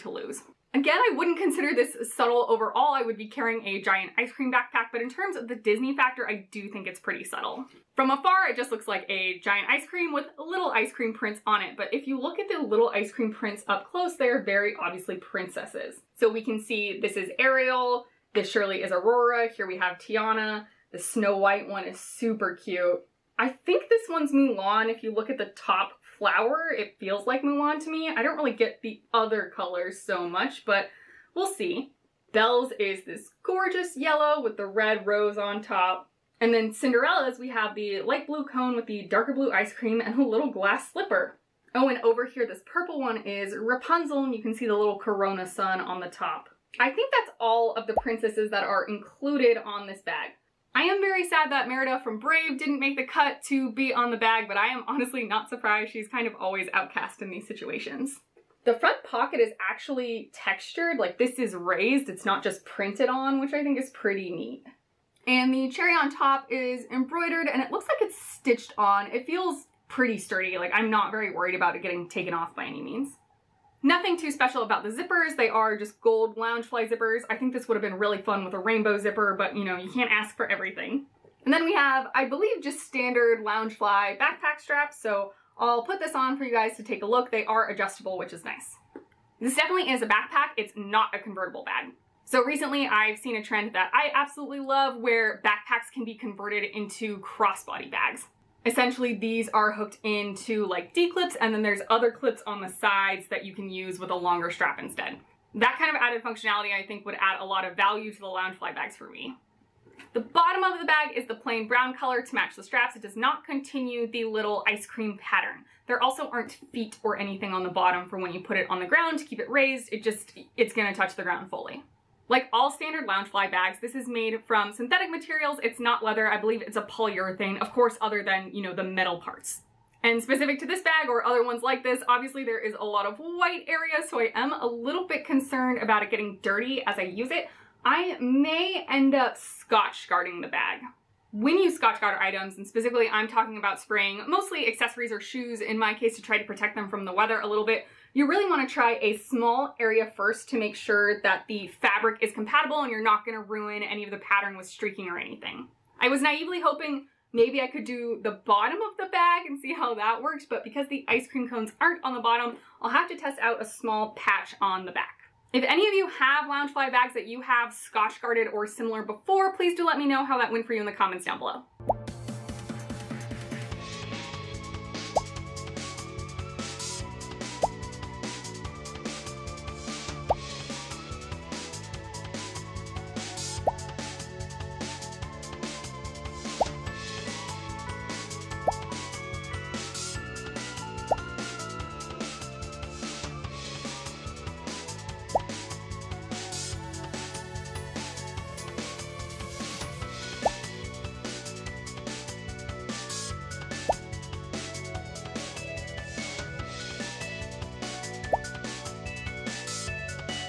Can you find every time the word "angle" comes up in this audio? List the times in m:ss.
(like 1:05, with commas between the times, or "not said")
not said.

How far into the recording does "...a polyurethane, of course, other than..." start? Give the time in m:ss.
2:06.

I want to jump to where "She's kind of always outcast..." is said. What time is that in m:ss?
0:55.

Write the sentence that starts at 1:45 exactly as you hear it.
That kind of added functionality I think would add a lot of value to the Loungefly bags for me.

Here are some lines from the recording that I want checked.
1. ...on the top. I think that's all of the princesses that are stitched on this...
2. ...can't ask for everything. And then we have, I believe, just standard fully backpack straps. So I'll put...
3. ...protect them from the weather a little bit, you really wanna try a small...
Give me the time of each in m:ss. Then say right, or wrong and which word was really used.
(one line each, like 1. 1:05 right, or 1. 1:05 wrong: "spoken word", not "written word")
1. 0:45 wrong: "included", not "stitched"
2. 1:19 wrong: "loungefly", not "fully"
3. 2:26 right.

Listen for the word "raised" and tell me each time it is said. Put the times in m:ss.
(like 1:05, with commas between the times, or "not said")
1:01, 1:59.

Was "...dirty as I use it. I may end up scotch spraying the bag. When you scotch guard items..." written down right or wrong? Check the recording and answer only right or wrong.
wrong.